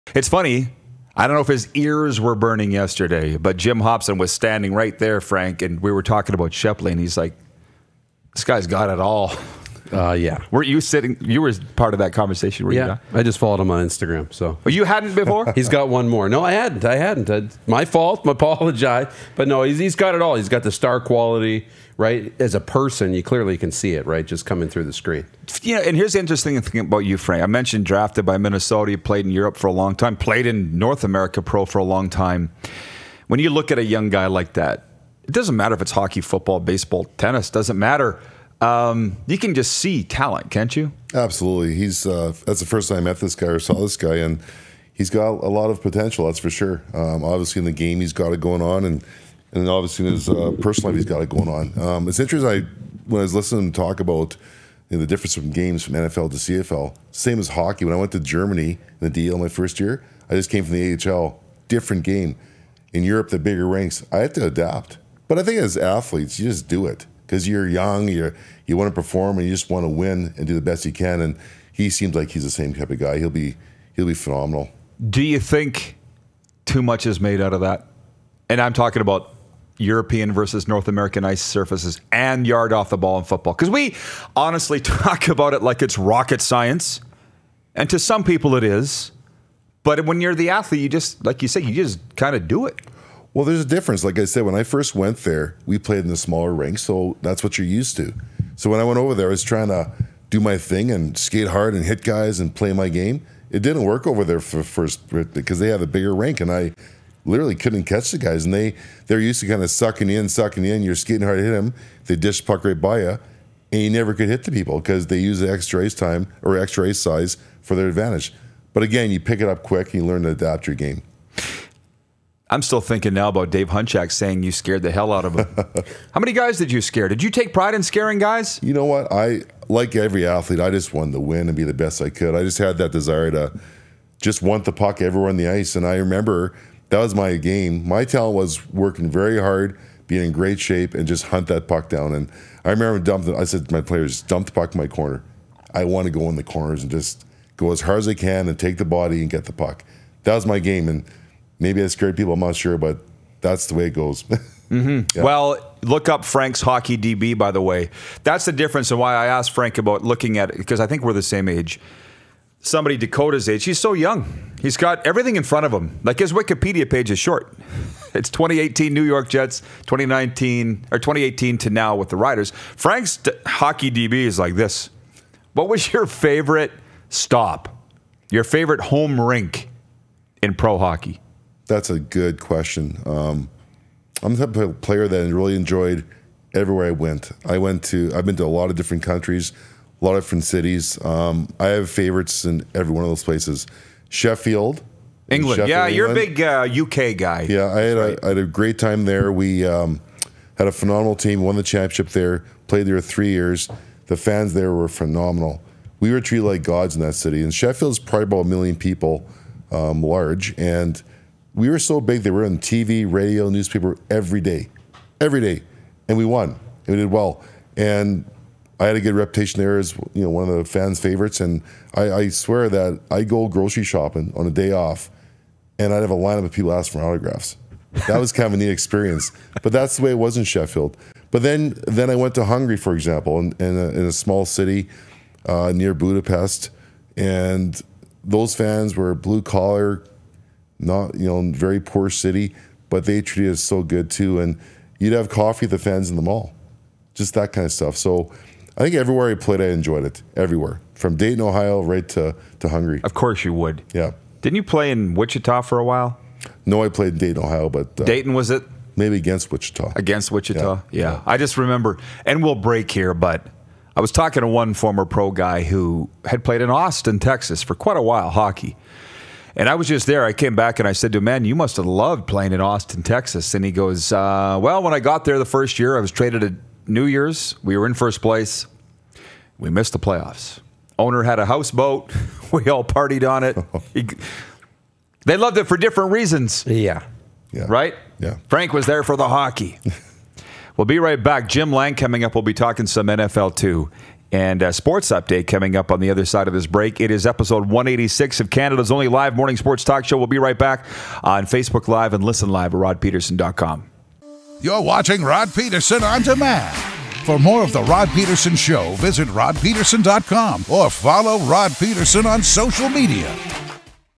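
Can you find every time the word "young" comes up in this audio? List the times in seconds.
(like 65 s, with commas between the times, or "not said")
33 s, 67 s, 163 s.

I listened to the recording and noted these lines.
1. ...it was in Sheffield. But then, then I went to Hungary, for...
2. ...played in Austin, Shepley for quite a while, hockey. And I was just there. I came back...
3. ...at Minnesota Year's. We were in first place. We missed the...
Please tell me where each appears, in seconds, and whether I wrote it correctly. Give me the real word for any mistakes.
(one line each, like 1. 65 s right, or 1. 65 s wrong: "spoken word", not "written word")
1. 230 s right
2. 266 s wrong: "Texas", not "Shepley"
3. 276 s wrong: "New", not "Minnesota".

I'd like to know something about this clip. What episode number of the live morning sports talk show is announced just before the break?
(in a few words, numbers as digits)
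186.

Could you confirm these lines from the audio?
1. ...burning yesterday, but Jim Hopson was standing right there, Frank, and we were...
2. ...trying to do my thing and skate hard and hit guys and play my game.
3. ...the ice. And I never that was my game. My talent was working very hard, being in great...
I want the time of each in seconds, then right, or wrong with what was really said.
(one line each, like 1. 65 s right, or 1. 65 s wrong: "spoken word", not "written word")
1. 2 s right
2. 99 s right
3. 135 s wrong: "remember", not "never".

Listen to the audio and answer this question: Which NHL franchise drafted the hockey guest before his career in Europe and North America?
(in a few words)
Minnesota.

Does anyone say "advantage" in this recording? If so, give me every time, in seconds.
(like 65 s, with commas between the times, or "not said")
117 s.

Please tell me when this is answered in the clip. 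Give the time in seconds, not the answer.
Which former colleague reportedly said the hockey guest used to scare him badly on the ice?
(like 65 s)
123 s.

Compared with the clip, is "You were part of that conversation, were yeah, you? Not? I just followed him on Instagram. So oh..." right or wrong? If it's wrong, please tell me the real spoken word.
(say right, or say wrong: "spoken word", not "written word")
right.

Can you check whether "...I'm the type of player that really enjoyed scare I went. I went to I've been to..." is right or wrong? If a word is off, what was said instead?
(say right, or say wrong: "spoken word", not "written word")
wrong: "everywhere", not "scare".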